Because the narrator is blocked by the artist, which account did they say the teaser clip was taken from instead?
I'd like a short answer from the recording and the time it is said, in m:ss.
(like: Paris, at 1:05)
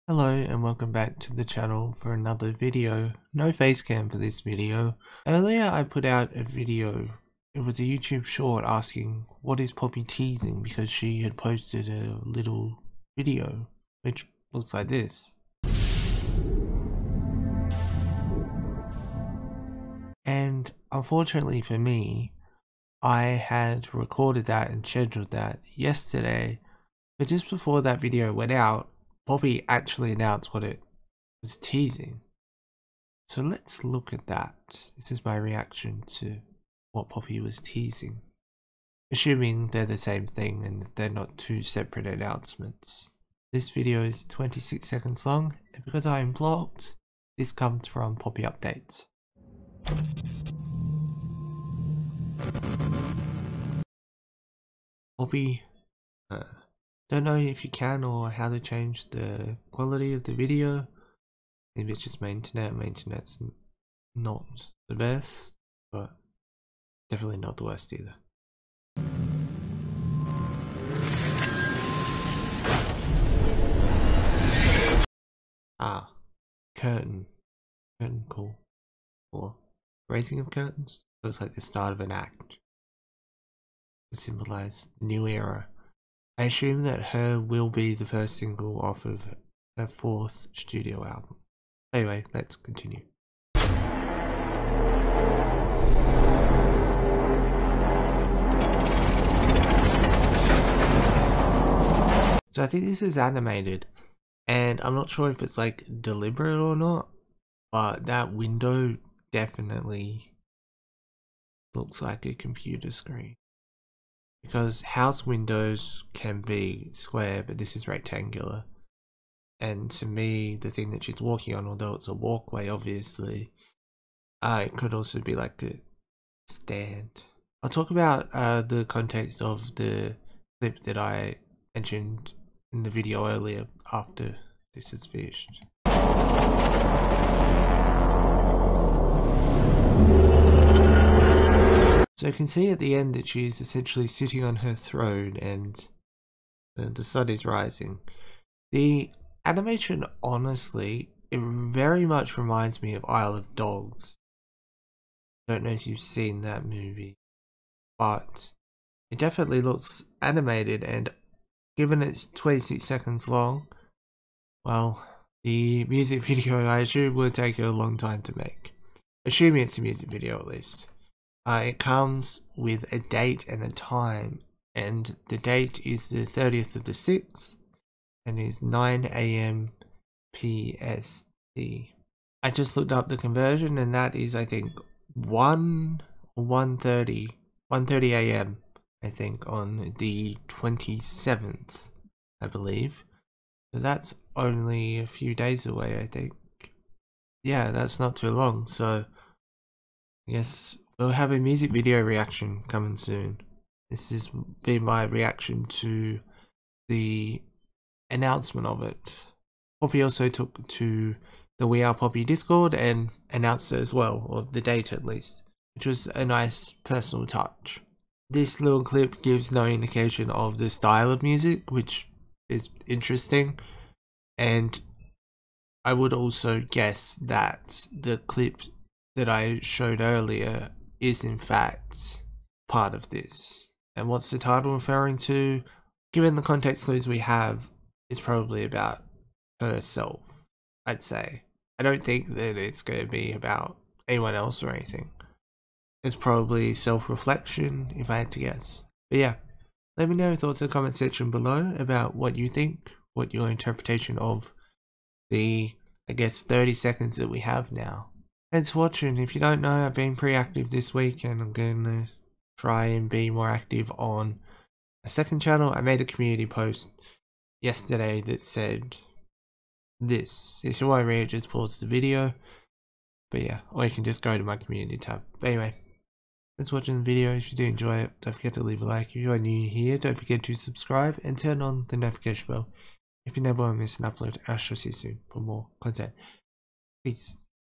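Poppy Updates, at 0:48.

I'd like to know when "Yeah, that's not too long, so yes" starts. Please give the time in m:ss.
3:17.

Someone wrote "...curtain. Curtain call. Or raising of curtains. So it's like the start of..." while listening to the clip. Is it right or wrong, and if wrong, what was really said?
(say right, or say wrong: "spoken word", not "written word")
right.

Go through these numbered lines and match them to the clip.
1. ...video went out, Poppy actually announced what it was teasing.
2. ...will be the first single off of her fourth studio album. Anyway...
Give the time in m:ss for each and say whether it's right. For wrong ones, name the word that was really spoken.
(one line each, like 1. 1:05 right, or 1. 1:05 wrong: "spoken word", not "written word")
1. 0:28 right
2. 1:27 right.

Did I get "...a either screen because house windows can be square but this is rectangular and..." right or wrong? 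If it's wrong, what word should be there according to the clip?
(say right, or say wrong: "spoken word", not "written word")
wrong: "computer", not "either".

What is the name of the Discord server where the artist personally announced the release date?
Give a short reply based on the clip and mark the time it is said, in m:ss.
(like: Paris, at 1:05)
We Are Poppy, at 3:31.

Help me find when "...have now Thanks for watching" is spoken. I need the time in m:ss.
4:17.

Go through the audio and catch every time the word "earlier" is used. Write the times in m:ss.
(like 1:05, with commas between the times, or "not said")
0:05, 2:13, 3:49.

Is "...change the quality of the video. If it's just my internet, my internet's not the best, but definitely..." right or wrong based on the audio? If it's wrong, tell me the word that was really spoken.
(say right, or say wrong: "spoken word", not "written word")
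right.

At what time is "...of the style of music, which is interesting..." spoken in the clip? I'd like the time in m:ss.
3:40.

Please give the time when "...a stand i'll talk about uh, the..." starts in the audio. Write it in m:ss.
2:05.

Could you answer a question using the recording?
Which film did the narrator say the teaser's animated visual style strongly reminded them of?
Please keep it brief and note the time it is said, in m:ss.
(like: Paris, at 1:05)
Isle of Dogs, at 2:33.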